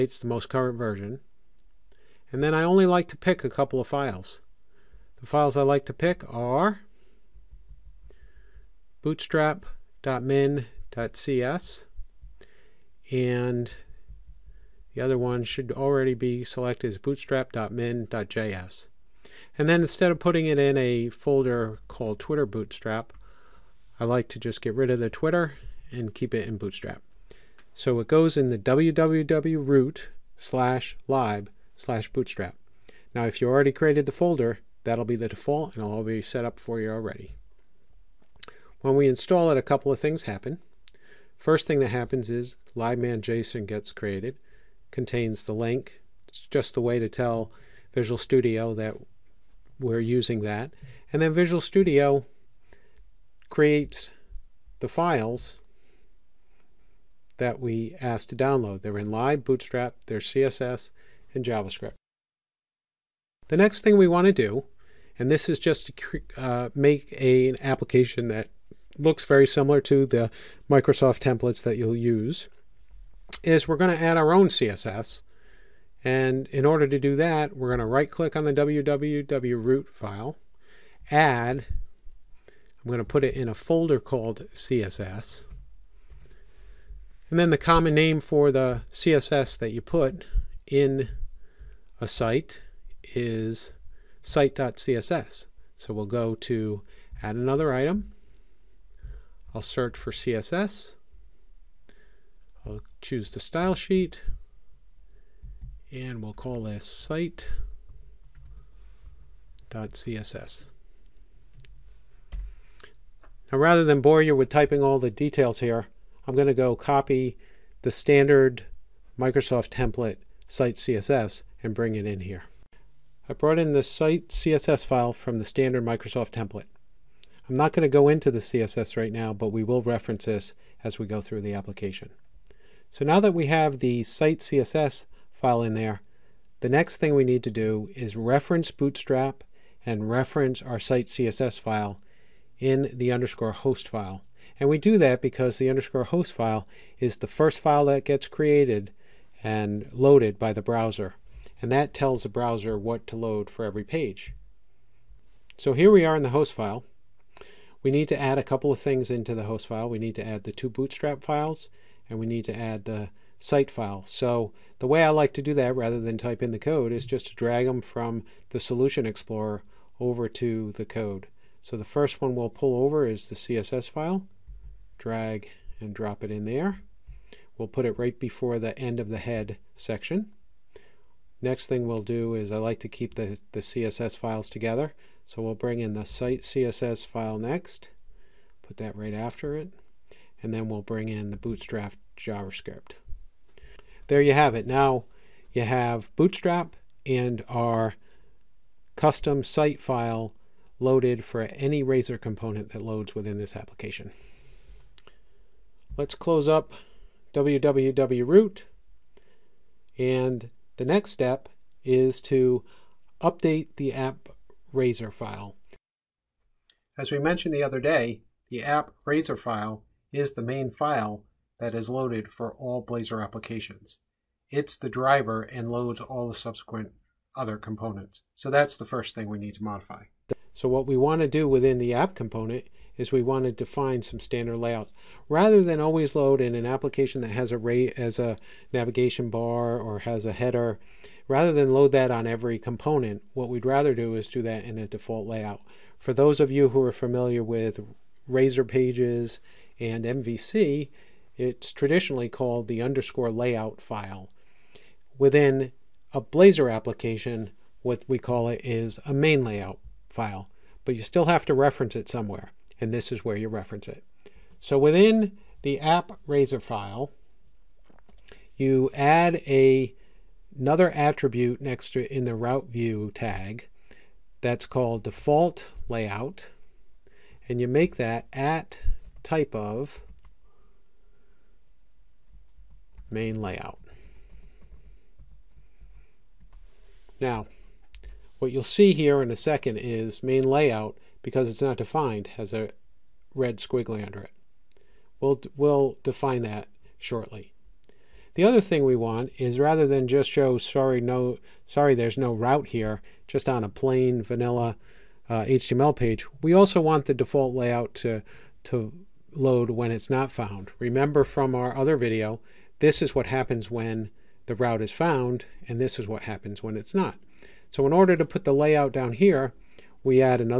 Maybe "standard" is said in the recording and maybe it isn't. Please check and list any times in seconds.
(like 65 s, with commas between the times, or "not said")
117 s, 125 s, 234 s.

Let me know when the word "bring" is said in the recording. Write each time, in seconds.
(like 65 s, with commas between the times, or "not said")
121 s, 185 s, 190 s.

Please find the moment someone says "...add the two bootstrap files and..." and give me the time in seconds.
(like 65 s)
160 s.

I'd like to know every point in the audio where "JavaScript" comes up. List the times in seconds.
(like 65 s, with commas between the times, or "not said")
61 s, 192 s.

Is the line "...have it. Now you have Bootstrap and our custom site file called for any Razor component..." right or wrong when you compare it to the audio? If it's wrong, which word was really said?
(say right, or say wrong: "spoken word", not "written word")
wrong: "loaded", not "called".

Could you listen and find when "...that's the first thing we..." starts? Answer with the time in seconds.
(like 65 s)
228 s.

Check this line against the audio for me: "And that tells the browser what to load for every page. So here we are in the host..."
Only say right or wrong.
right.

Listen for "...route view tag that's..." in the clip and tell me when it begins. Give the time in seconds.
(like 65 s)
272 s.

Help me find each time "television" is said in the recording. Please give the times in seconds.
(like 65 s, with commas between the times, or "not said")
not said.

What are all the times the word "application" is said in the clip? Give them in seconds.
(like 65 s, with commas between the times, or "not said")
67 s, 131 s, 203 s, 223 s, 236 s, 256 s.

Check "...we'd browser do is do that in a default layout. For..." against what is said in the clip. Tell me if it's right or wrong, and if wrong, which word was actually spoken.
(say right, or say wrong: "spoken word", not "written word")
wrong: "rather", not "browser".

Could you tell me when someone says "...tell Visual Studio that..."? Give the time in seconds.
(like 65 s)
47 s.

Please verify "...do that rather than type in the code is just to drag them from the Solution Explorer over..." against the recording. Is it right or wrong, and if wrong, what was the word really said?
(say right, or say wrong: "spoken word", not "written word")
right.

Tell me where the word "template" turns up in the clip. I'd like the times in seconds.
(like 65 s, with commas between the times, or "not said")
71 s, 119 s, 126 s.